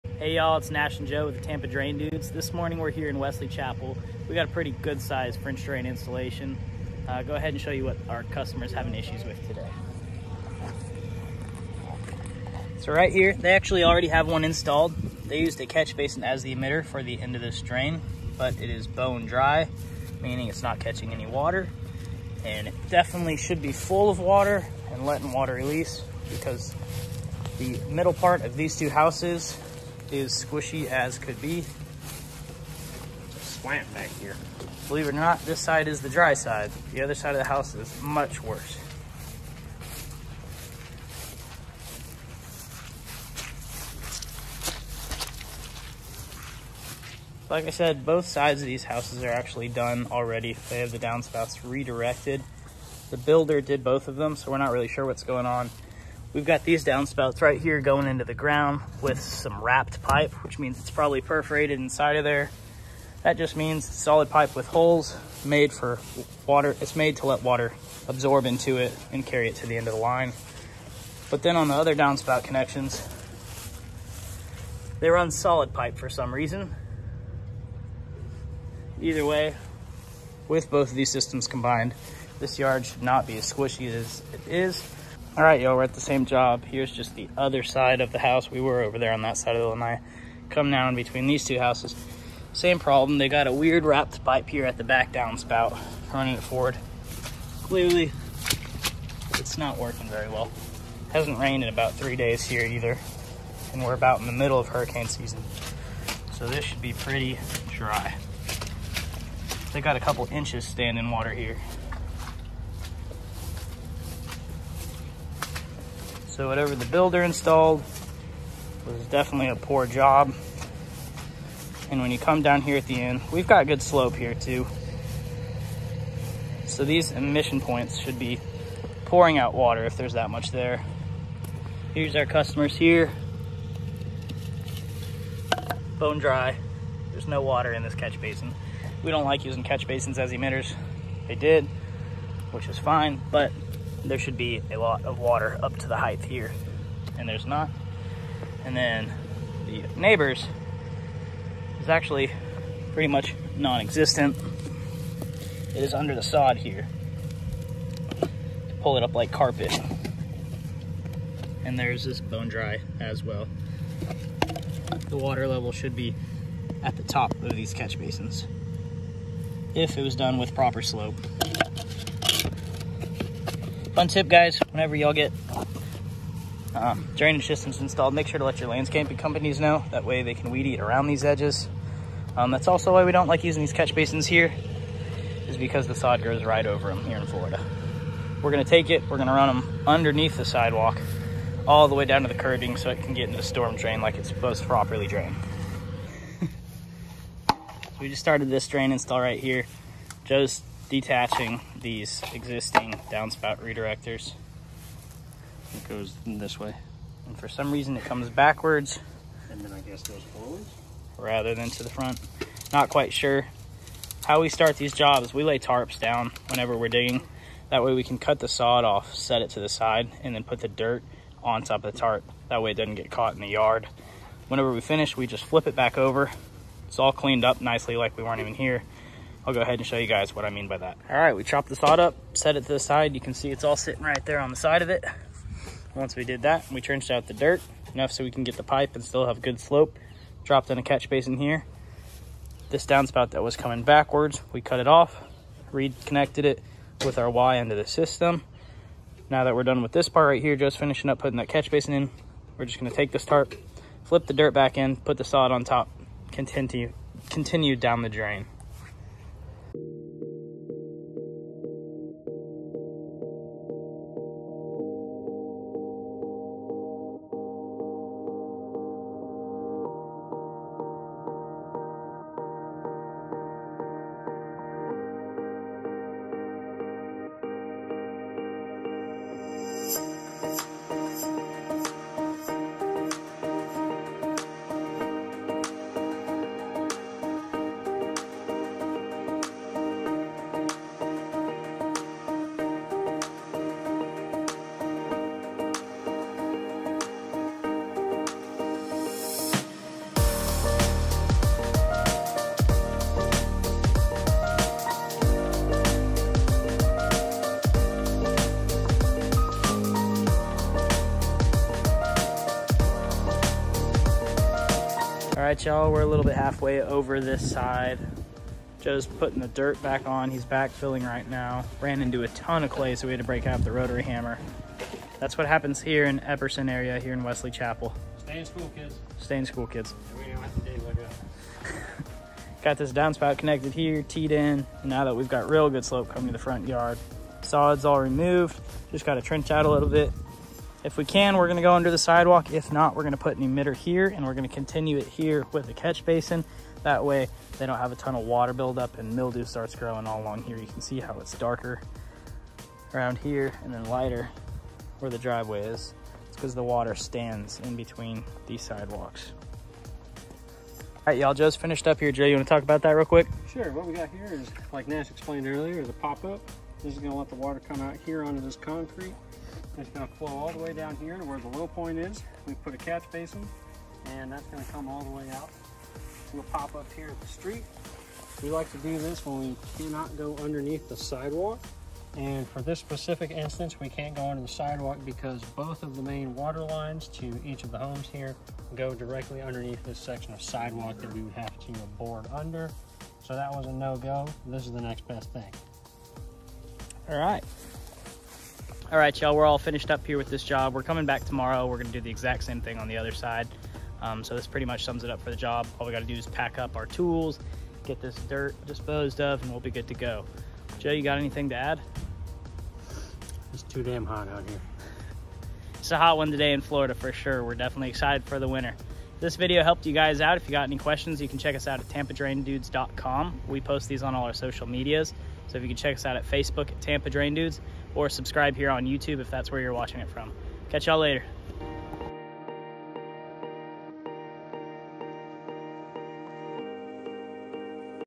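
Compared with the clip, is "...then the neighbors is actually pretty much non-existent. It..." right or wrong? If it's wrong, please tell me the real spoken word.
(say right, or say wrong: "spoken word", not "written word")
right.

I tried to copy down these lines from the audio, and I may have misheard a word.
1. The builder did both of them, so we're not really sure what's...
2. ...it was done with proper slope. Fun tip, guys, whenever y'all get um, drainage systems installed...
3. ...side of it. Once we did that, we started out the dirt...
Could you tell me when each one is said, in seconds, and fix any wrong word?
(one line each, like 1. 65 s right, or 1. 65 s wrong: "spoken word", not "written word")
1. 53 s right
2. 169 s right
3. 234 s wrong: "trenched", not "started".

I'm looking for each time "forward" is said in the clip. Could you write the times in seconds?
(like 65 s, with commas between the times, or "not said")
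96 s, 210 s.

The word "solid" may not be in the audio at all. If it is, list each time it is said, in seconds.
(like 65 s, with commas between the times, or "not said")
63 s, 75 s.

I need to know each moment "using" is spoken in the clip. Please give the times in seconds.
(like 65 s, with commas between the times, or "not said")
139 s, 183 s.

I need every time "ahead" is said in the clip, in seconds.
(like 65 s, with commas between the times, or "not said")
7 s, 229 s.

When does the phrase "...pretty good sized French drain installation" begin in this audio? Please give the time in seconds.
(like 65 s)
4 s.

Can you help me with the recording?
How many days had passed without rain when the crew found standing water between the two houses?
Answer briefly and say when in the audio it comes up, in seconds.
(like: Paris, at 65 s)
3, at 101 s.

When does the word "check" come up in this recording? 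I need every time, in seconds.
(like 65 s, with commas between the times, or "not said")
421 s, 425 s.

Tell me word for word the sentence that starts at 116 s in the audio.
So whatever the builder installed was definitely a poor job.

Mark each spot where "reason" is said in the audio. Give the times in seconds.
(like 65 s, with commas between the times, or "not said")
76 s, 207 s.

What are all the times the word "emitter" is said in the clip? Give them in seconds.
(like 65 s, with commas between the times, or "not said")
16 s, 140 s, 343 s.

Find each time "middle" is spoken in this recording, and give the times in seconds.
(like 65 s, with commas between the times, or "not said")
27 s, 104 s.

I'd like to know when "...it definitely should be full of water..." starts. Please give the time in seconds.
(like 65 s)
22 s.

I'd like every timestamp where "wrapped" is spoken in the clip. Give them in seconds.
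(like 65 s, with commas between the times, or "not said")
59 s, 93 s.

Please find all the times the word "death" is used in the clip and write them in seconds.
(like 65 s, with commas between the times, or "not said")
not said.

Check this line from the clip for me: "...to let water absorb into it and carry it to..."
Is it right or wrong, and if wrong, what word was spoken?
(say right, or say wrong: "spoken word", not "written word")
right.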